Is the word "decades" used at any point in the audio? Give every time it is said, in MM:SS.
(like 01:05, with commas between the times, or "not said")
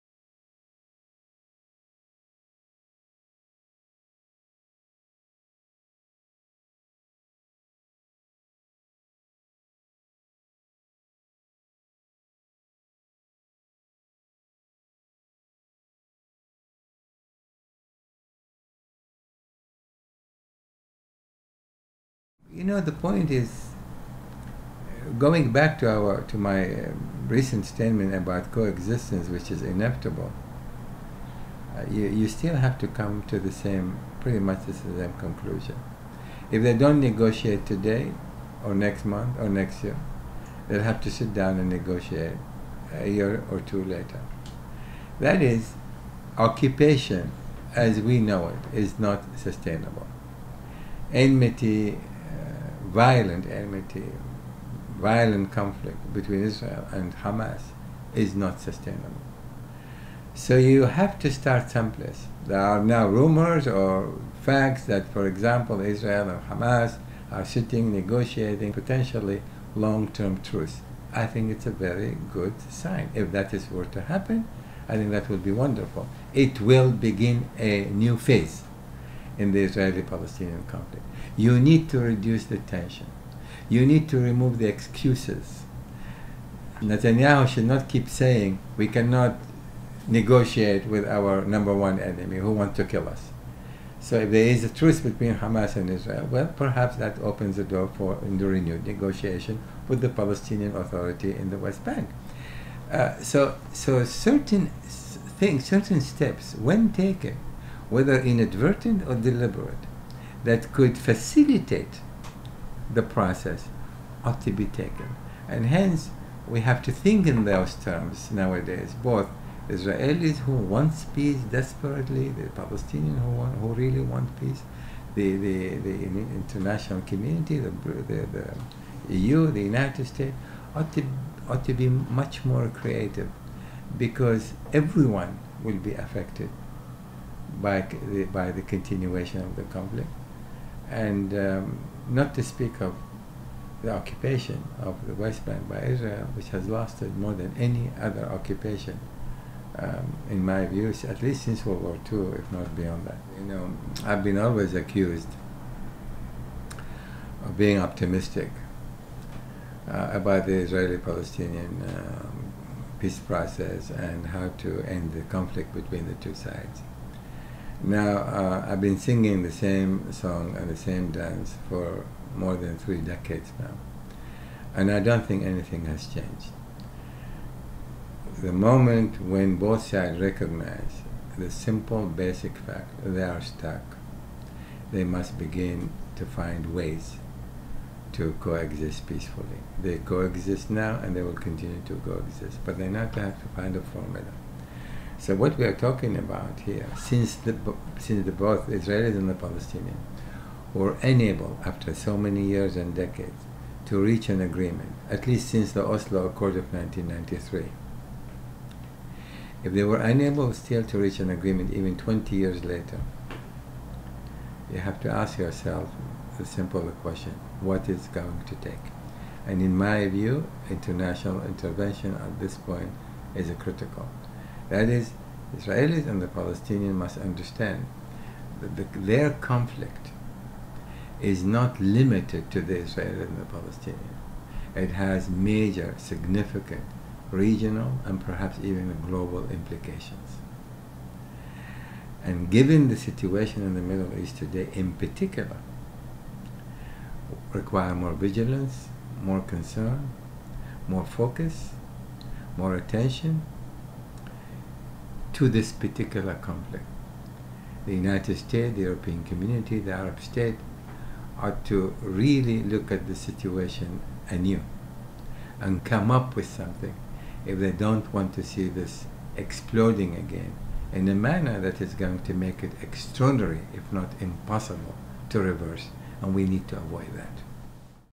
02:53, 03:22.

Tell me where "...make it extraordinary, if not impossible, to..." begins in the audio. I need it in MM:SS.
04:32.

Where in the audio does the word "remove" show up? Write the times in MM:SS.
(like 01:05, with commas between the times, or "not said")
01:24.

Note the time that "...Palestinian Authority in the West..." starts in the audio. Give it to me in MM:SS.
01:40.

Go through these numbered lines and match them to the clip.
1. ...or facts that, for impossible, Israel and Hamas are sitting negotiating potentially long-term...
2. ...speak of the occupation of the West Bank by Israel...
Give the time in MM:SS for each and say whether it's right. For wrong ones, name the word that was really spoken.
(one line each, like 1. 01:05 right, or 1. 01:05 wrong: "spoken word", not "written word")
1. 01:03 wrong: "example", not "impossible"
2. 02:22 right.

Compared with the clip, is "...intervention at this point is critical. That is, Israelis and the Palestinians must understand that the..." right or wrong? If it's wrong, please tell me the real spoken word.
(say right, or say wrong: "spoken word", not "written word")
right.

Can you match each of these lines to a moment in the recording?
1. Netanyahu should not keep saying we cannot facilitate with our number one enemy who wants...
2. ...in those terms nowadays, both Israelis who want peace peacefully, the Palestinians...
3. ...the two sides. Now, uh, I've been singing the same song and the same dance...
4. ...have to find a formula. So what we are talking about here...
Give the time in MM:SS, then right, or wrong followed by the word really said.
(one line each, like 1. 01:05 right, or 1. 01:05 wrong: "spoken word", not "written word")
1. 01:26 wrong: "negotiate", not "facilitate"
2. 01:57 wrong: "desperately", not "peacefully"
3. 02:46 right
4. 03:13 right.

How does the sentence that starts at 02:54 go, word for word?
And I don't think anything has changed.